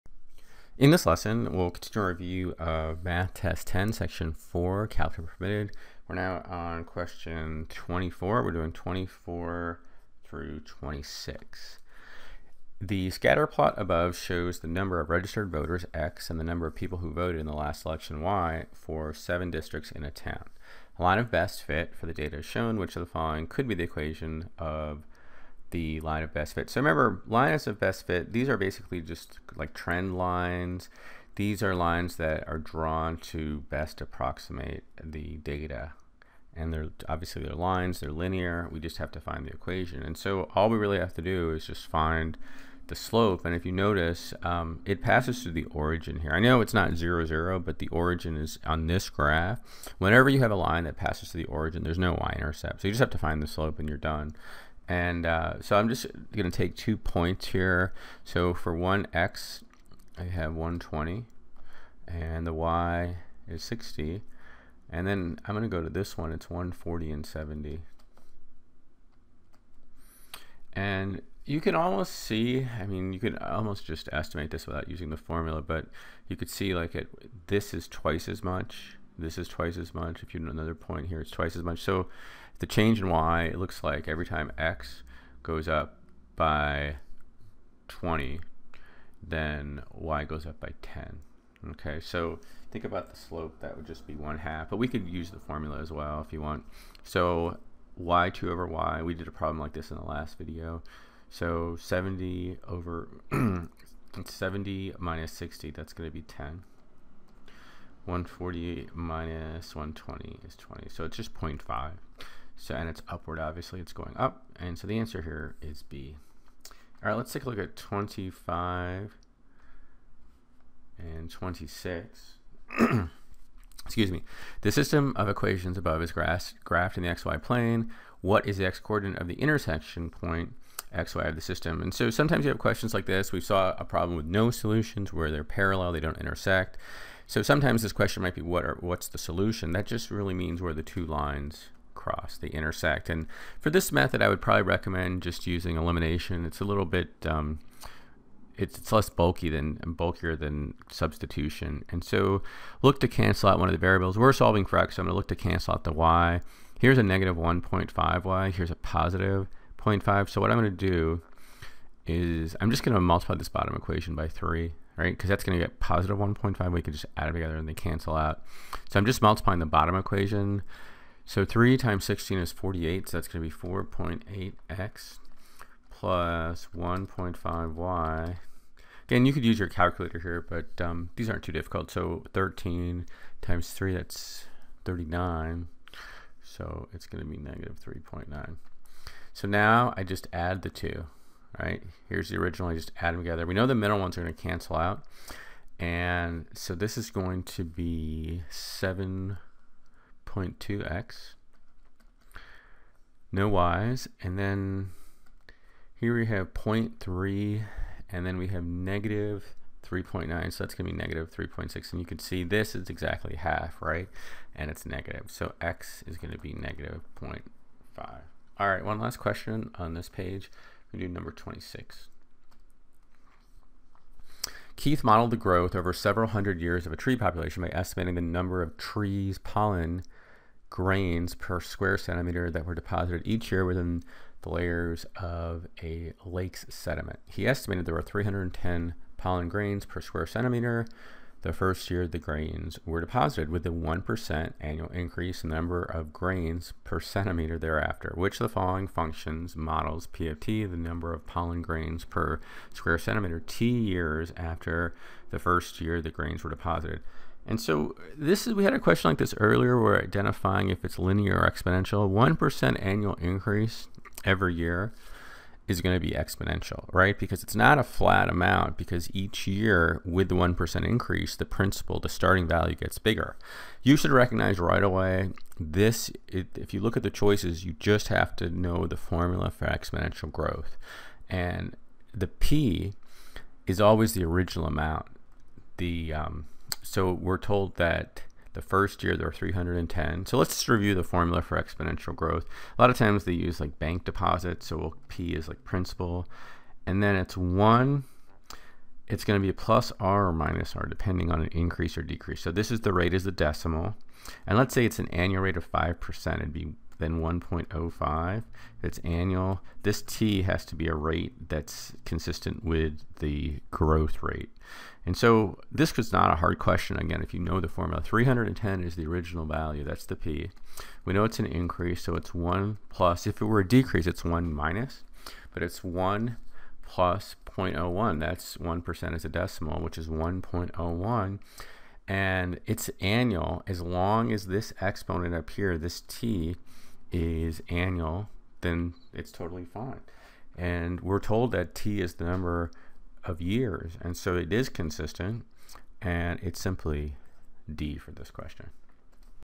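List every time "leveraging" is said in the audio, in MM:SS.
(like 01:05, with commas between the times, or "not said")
not said.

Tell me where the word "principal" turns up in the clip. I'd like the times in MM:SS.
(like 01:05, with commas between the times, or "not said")
04:31, 04:55.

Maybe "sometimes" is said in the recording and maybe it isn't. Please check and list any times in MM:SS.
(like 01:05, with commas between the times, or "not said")
02:12, 02:17.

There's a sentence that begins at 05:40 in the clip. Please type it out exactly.
And we're told that T is the number of years, and so it is consistent, and it's simply D for this question.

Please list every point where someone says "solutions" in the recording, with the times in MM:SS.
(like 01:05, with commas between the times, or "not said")
02:14, 02:19.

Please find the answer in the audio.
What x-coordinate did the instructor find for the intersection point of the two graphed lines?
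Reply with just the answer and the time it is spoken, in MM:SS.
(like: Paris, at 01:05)
-0.5, at 03:36.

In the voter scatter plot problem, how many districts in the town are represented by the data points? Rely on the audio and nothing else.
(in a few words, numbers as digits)
7.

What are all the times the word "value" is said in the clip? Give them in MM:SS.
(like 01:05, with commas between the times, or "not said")
04:32, 05:19.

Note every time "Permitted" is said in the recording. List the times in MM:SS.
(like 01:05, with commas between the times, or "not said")
00:05.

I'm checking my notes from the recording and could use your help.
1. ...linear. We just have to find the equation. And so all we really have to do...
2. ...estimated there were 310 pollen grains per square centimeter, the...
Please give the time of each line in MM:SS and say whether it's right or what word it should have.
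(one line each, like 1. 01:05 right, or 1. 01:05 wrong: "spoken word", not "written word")
1. 00:38 right
2. 03:57 right.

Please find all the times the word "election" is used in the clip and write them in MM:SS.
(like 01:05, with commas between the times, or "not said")
00:17.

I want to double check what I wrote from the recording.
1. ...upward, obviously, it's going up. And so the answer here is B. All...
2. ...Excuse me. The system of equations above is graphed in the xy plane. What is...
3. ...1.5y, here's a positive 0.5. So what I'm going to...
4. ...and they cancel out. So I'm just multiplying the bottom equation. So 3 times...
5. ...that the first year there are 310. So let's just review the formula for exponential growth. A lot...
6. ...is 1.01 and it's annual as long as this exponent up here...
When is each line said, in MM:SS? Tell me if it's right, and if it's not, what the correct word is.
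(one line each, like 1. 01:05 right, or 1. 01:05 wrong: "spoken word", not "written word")
1. 01:53 right
2. 02:03 right
3. 02:37 right
4. 02:47 right
5. 04:47 right
6. 05:29 right.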